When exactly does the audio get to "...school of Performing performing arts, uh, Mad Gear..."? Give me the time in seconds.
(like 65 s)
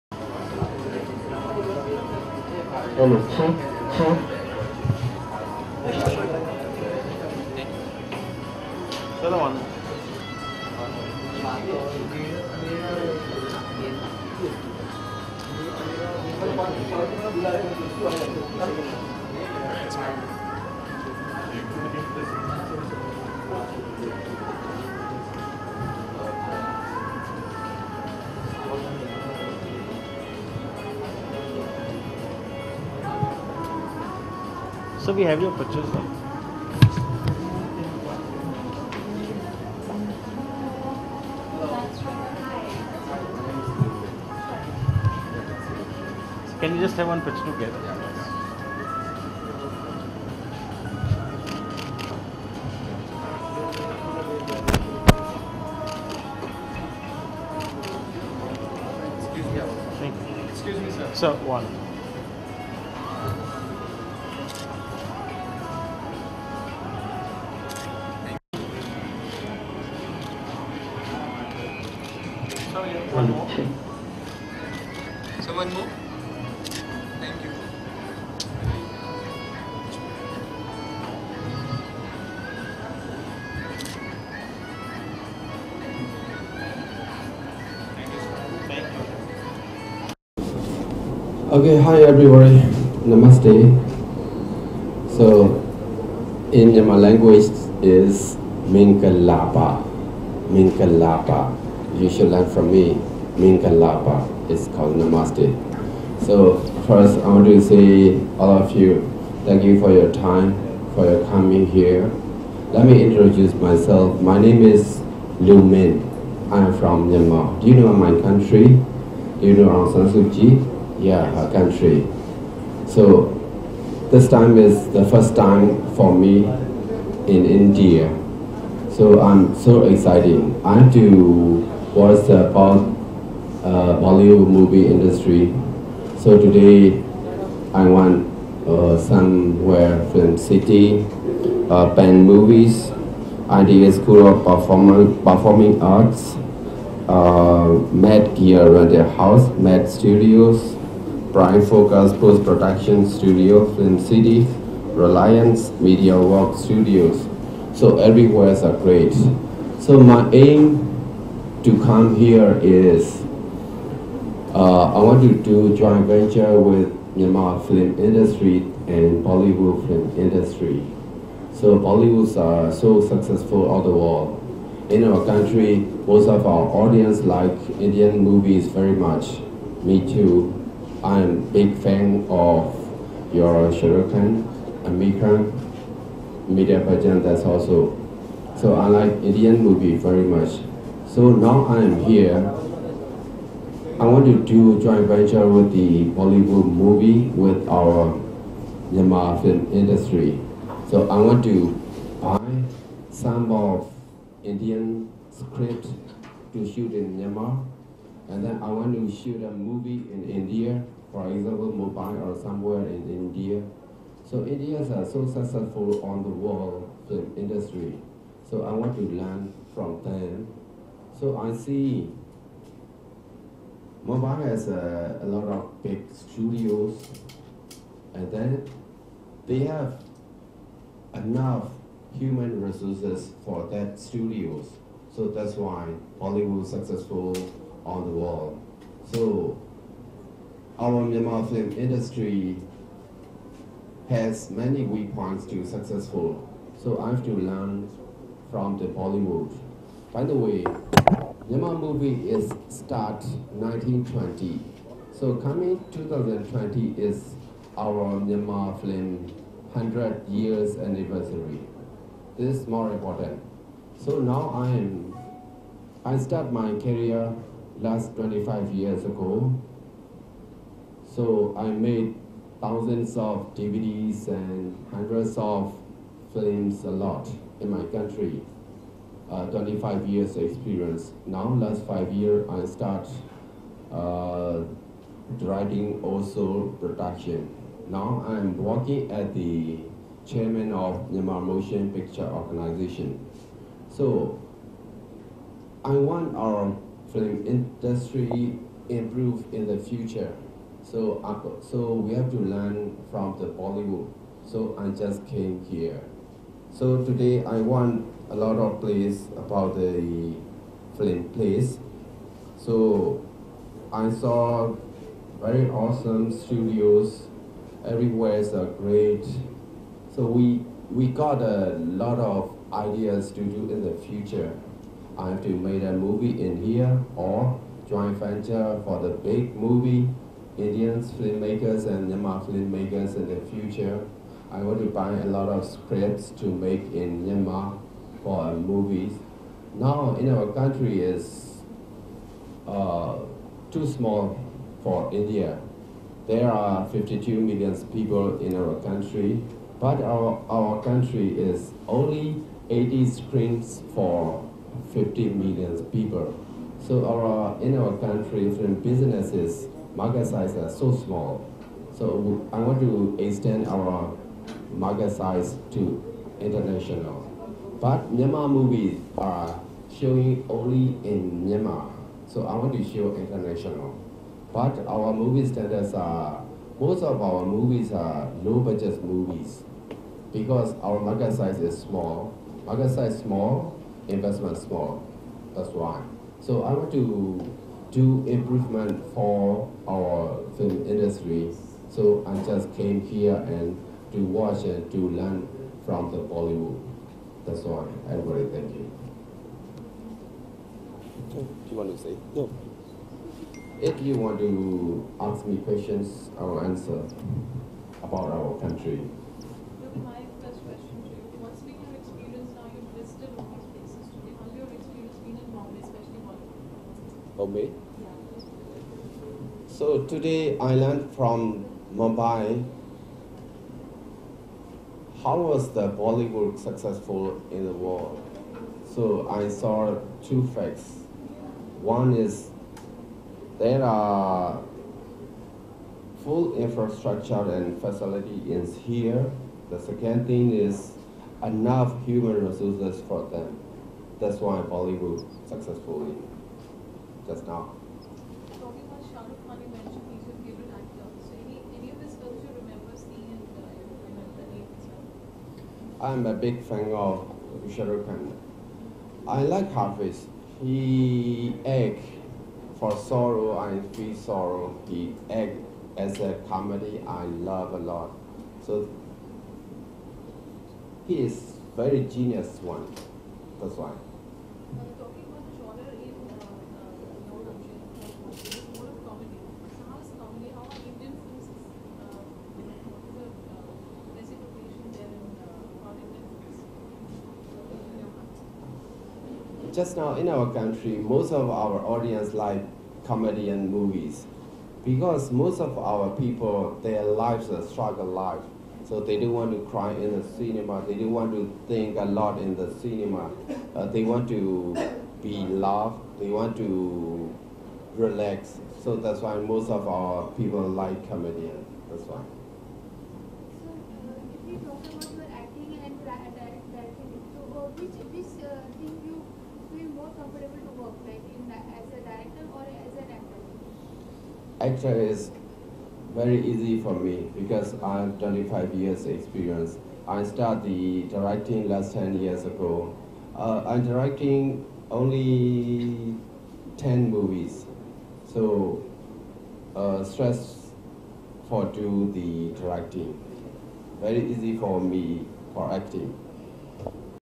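143 s.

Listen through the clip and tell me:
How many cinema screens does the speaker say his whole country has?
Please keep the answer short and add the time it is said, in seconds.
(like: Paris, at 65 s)
80, at 351 s.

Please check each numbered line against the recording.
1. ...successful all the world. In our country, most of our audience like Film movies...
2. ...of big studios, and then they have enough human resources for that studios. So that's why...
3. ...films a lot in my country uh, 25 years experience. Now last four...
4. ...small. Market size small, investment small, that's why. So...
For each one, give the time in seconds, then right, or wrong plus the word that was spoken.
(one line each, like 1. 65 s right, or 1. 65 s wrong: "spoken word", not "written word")
1. 173 s wrong: "Indian", not "Film"
2. 225 s right
3. 276 s wrong: "five", not "four"
4. 381 s right.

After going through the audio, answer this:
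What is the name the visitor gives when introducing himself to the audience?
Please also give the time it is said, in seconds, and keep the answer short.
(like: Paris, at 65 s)
Lu Min, at 114 s.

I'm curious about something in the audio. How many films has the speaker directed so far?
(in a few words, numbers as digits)
10.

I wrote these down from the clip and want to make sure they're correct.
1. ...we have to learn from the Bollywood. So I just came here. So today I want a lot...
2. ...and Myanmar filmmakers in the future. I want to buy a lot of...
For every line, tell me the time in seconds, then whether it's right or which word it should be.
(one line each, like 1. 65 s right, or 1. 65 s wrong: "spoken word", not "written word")
1. 301 s right
2. 331 s right.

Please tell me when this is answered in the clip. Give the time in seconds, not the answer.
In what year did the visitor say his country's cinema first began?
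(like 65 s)
251 s.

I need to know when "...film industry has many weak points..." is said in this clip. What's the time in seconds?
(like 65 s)
241 s.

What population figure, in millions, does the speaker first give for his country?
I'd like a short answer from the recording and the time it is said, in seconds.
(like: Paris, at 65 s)
52 million, at 346 s.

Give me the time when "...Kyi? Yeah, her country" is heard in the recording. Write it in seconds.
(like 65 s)
120 s.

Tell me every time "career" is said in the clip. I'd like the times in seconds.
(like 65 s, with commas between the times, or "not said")
266 s.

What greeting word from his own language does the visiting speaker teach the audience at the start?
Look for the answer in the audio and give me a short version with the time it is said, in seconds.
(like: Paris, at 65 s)
Mingalaba, at 95 s.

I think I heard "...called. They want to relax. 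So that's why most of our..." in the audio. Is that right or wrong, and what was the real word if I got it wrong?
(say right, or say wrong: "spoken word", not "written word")
wrong: "loved", not "called".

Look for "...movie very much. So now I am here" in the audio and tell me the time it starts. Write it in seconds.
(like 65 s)
189 s.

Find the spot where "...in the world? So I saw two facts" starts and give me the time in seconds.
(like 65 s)
427 s.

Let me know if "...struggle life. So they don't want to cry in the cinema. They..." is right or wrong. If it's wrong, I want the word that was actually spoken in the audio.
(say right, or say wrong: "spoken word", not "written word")
right.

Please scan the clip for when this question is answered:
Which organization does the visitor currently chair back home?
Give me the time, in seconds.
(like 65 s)
291 s.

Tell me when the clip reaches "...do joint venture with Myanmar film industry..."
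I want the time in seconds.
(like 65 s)
165 s.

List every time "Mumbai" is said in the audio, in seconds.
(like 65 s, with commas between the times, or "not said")
211 s, 421 s.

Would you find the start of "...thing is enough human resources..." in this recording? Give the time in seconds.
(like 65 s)
440 s.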